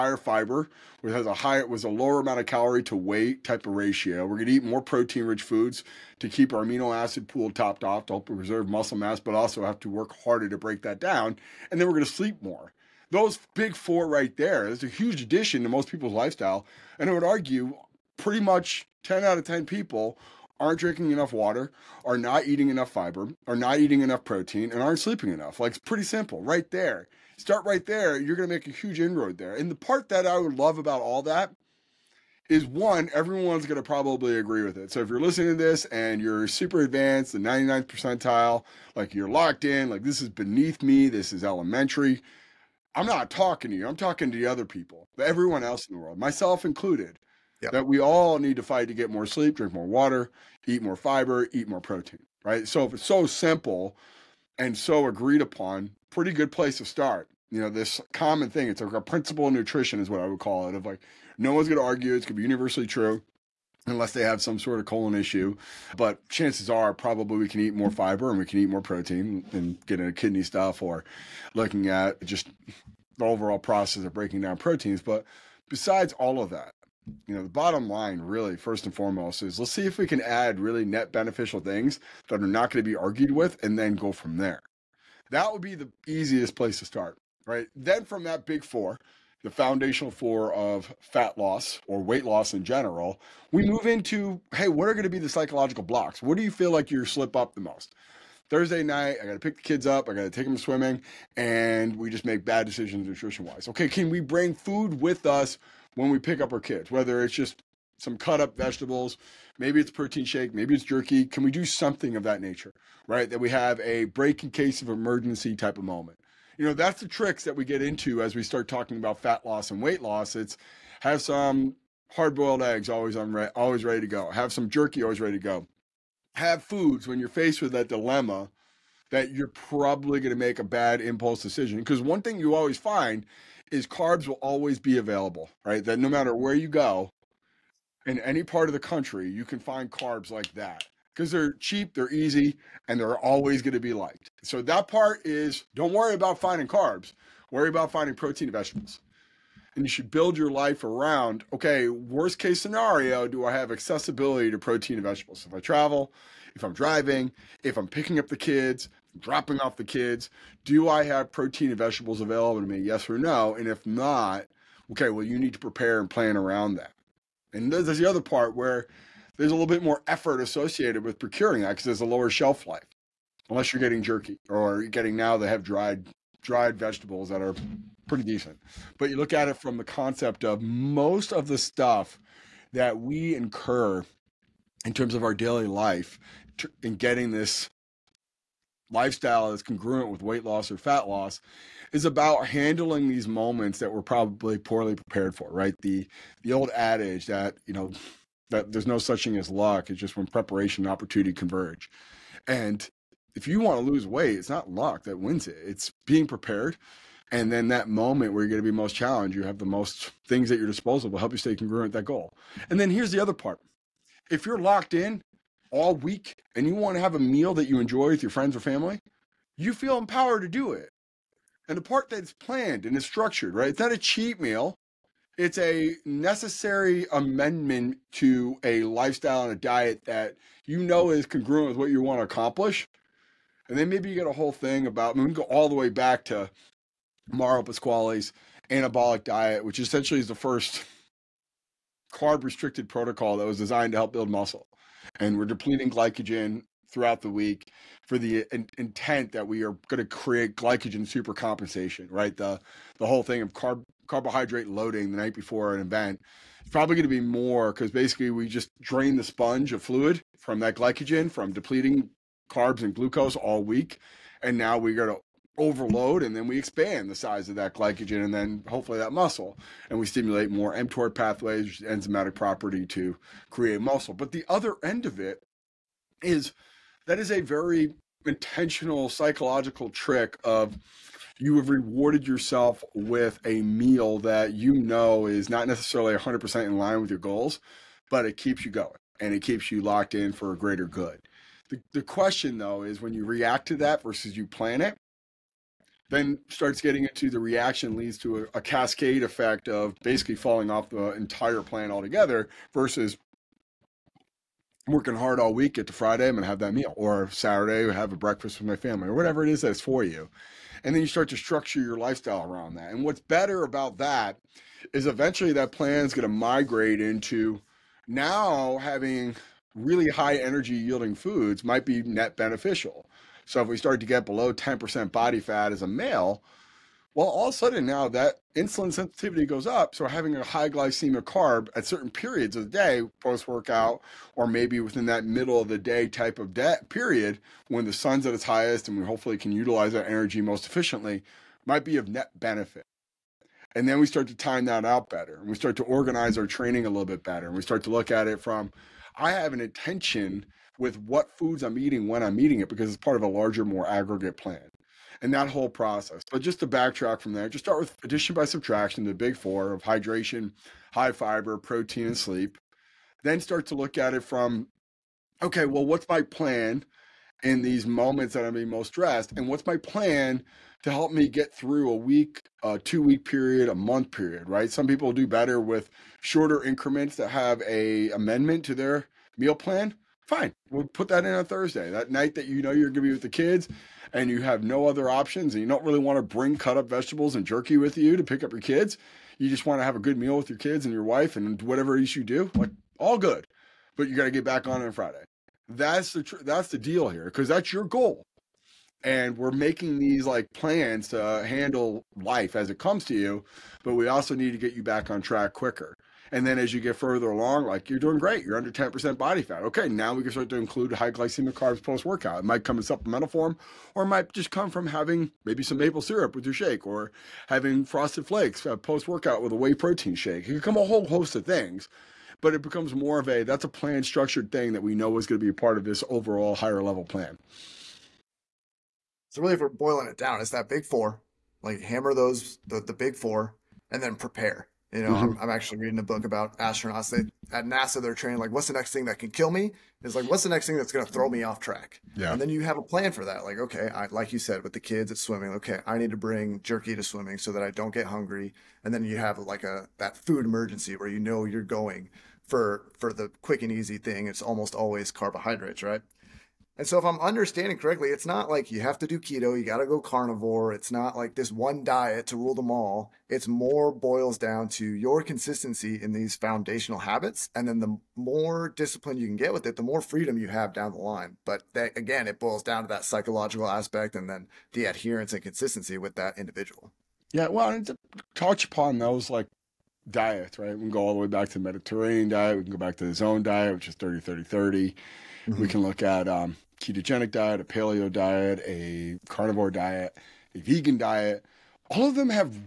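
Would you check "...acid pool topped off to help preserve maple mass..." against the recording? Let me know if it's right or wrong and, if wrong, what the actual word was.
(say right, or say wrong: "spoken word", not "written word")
wrong: "muscle", not "maple".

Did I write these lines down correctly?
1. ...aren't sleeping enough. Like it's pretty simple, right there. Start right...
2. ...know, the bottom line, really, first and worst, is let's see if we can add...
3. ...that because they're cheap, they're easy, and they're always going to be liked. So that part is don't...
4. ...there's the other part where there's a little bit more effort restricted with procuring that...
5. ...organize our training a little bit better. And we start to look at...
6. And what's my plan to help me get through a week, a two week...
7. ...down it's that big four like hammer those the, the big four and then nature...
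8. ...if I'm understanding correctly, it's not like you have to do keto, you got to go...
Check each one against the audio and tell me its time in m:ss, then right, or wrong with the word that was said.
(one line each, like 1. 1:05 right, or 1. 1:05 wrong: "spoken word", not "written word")
1. 0:24 right
2. 1:17 wrong: "foremost", not "worst"
3. 2:20 right
4. 2:47 wrong: "associated", not "restricted"
5. 5:45 right
6. 6:09 right
7. 7:10 wrong: "prepare", not "nature"
8. 7:36 right.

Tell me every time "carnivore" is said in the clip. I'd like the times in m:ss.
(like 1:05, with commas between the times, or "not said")
7:39, 8:09.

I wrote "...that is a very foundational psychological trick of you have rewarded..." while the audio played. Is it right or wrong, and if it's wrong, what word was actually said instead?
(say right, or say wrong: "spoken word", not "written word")
wrong: "intentional", not "foundational".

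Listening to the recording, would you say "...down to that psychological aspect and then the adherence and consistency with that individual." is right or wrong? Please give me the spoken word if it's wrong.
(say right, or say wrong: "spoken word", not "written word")
right.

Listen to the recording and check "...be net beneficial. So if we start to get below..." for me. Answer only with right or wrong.
right.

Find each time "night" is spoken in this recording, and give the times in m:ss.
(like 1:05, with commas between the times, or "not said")
1:38, 4:15, 6:22.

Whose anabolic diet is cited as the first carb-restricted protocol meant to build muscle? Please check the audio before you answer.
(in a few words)
Mario Pasquale.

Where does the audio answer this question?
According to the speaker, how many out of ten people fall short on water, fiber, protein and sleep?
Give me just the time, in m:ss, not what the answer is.
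0:19.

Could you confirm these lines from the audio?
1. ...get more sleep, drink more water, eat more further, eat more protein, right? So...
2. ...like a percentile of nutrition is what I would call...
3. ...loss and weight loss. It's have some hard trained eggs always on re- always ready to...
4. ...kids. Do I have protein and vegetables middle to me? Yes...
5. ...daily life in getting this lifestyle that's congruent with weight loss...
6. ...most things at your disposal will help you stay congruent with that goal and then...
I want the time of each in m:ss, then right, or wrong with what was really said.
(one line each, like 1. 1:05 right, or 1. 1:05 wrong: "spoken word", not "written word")
1. 0:48 wrong: "fiber", not "further"
2. 0:58 wrong: "principle", not "percentile"
3. 1:59 wrong: "boiled", not "trained"
4. 2:39 wrong: "available", not "middle"
5. 3:05 right
6. 3:29 right.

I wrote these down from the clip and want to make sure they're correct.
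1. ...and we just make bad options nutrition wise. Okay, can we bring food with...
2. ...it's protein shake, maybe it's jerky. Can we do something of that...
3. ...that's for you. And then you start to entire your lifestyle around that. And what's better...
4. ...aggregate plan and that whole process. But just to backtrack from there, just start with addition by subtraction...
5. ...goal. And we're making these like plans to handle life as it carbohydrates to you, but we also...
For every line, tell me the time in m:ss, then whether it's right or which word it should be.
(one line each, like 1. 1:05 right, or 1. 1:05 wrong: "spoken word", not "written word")
1. 1:41 wrong: "decisions", not "options"
2. 1:49 right
3. 5:09 wrong: "structure", not "entire"
4. 5:53 right
5. 6:37 wrong: "comes", not "carbohydrates".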